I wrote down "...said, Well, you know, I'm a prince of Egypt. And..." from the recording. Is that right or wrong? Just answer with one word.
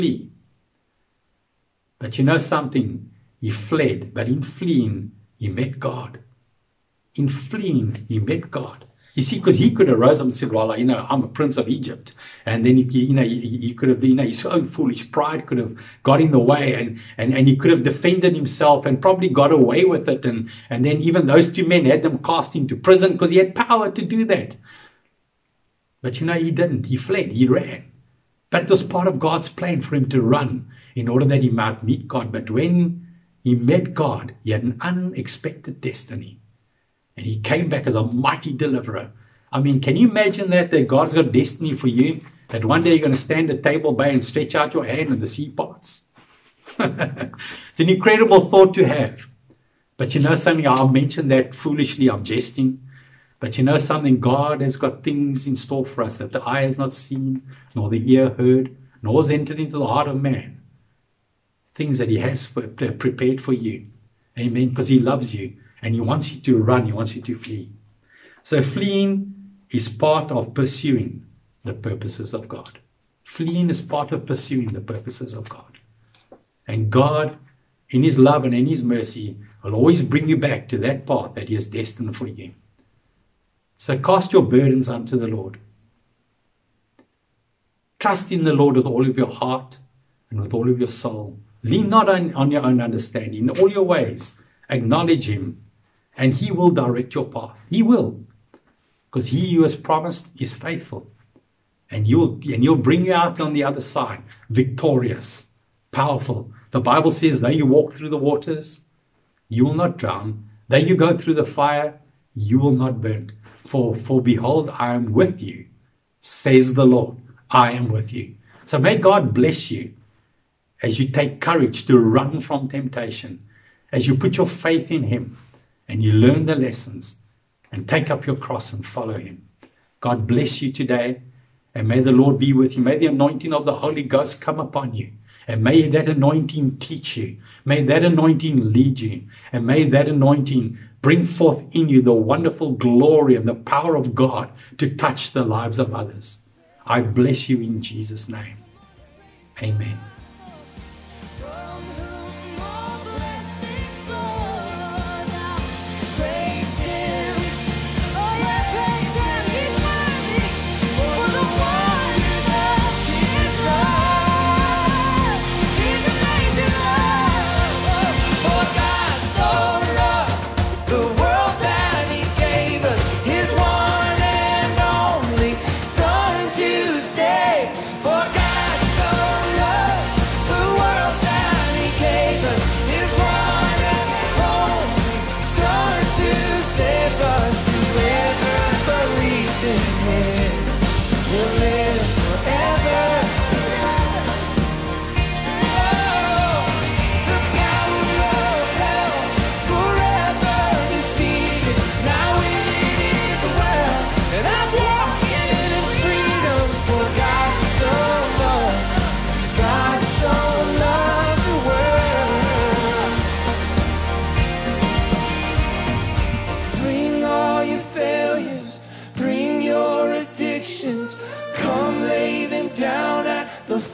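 right.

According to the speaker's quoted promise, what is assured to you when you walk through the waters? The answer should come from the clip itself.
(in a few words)
You will not drown.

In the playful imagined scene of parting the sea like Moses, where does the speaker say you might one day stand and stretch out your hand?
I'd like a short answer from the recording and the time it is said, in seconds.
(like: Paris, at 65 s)
Table Bay, at 43 s.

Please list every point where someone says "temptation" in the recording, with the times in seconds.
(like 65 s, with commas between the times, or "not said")
122 s.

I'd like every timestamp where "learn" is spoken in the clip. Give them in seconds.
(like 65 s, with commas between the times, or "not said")
126 s.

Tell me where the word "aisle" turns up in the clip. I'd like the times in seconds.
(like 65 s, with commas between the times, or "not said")
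not said.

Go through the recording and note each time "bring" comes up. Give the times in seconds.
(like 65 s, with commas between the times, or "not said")
80 s, 102 s, 141 s.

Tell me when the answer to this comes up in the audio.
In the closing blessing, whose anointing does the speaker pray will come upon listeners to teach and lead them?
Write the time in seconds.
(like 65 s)
133 s.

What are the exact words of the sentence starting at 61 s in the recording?
Things that He has prepared for you.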